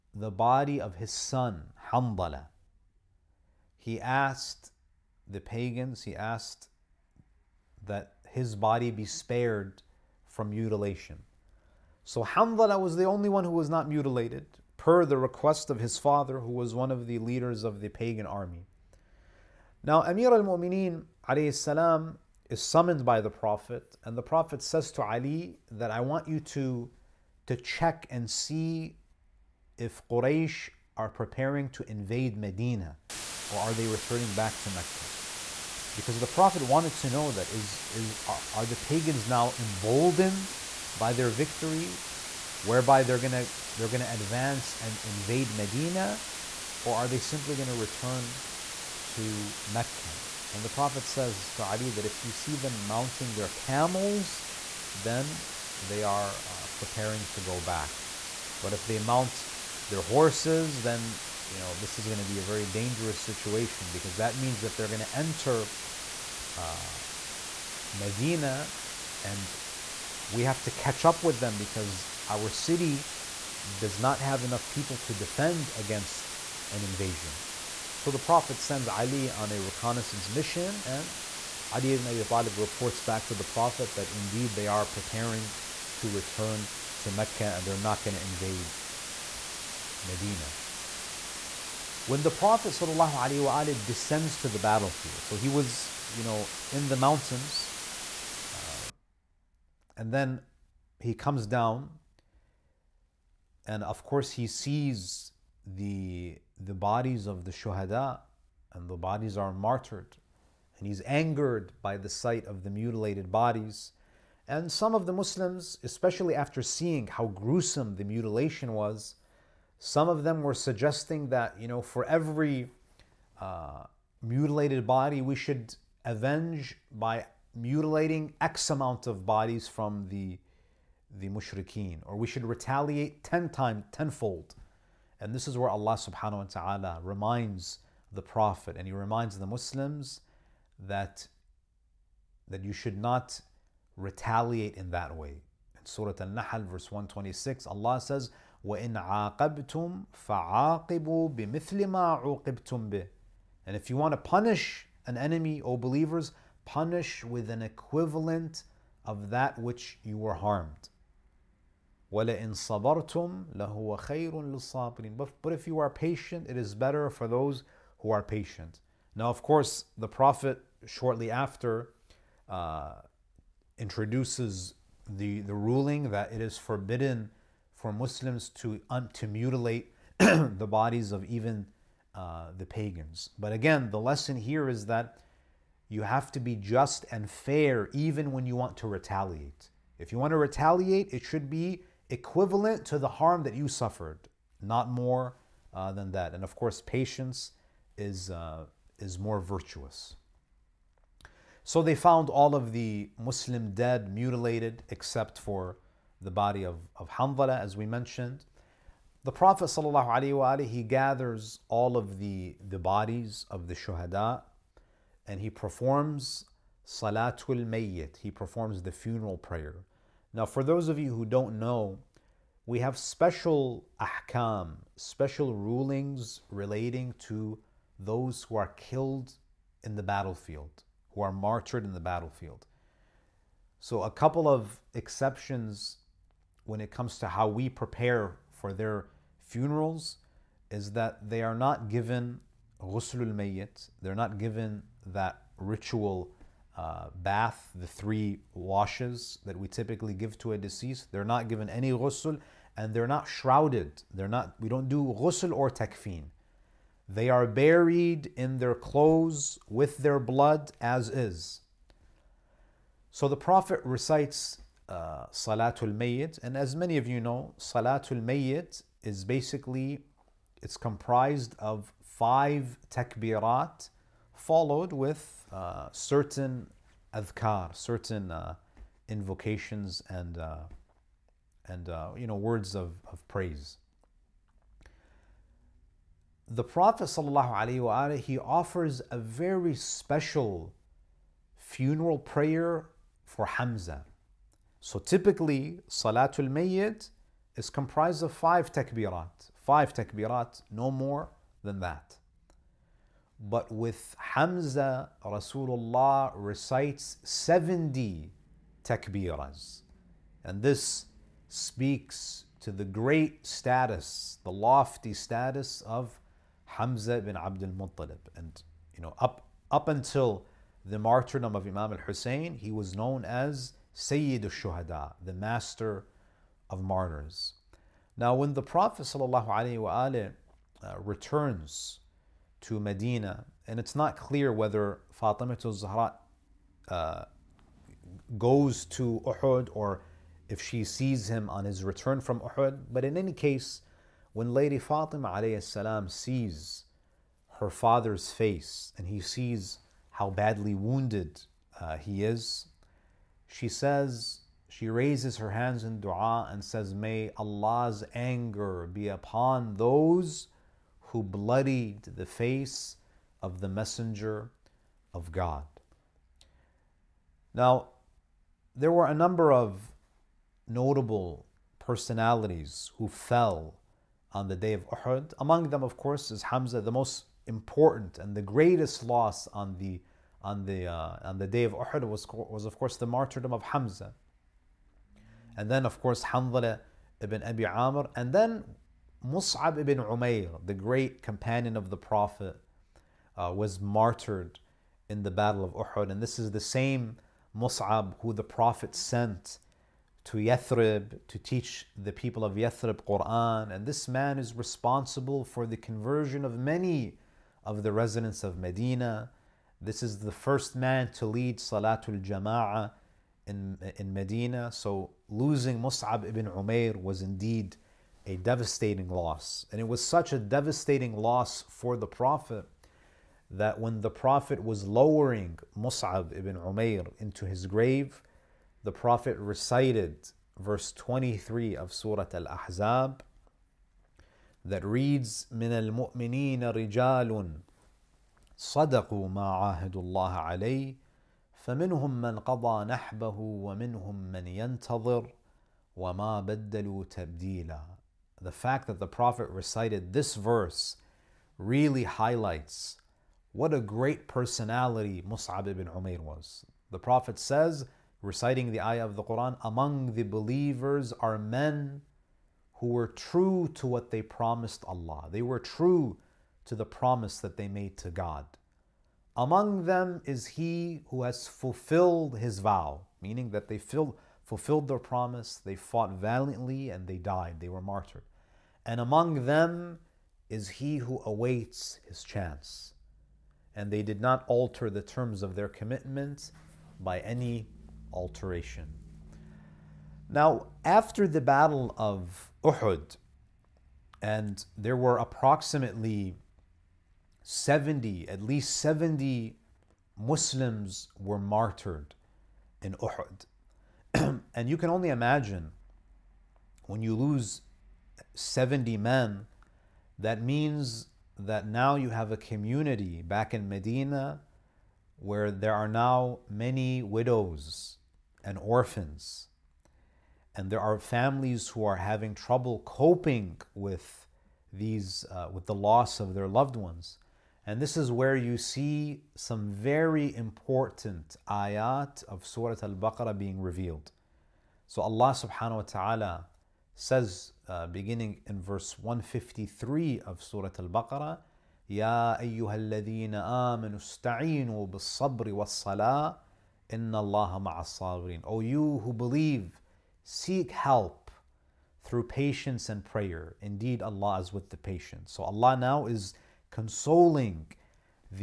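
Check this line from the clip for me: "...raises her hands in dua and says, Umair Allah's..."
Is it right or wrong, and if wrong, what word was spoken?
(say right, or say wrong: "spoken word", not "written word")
wrong: "May", not "Umair".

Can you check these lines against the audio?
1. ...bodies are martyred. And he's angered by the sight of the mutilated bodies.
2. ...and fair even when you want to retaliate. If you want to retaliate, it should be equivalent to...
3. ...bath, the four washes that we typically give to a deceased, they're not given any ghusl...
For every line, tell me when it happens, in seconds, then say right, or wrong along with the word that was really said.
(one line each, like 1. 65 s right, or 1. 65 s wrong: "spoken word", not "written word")
1. 108 s right
2. 187 s right
3. 247 s wrong: "three", not "four".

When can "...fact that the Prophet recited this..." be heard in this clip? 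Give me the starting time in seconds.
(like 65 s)
448 s.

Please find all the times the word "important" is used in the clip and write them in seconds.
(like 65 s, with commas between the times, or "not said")
377 s, 530 s.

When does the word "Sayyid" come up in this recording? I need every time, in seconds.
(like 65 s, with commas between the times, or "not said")
323 s.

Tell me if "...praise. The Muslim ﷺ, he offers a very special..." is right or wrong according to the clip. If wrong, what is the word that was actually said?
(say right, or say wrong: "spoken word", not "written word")
wrong: "Prophet", not "Muslim".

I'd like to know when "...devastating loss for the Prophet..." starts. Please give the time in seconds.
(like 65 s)
420 s.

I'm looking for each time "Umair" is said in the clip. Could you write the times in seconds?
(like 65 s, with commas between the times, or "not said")
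426 s, 455 s.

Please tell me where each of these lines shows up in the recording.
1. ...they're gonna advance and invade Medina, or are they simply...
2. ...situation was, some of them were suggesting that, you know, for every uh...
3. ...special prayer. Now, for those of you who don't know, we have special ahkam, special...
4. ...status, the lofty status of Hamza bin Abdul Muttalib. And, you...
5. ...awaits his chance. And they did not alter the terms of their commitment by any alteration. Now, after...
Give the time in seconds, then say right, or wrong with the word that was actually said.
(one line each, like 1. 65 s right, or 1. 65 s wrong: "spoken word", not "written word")
1. 43 s right
2. 118 s wrong: "mutilation", not "situation"
3. 218 s wrong: "funeral", not "special"
4. 313 s right
5. 481 s right.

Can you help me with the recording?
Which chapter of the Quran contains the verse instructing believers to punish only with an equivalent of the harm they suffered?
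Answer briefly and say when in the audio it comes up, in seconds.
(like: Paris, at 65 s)
Surah al Nahl, at 145 s.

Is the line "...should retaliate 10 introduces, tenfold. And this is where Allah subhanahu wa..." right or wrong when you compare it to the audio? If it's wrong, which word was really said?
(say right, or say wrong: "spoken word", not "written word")
wrong: "times", not "introduces".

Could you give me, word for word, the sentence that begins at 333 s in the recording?
And it's not clear whether Fatima to zahra uh, goes to Uhud or if she sees him on his return from Uhud.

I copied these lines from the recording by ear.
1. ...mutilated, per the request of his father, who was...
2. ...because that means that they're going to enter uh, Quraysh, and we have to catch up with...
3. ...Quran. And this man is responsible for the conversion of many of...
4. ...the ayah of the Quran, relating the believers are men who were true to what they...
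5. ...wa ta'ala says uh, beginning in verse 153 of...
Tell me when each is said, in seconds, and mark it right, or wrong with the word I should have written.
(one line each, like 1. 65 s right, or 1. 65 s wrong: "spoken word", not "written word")
1. 13 s right
2. 63 s wrong: "Medina", not "Quraysh"
3. 403 s right
4. 458 s wrong: "among", not "relating"
5. 535 s right.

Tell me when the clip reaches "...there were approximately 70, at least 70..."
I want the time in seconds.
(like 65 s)
494 s.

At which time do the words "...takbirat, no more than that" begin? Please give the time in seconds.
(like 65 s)
299 s.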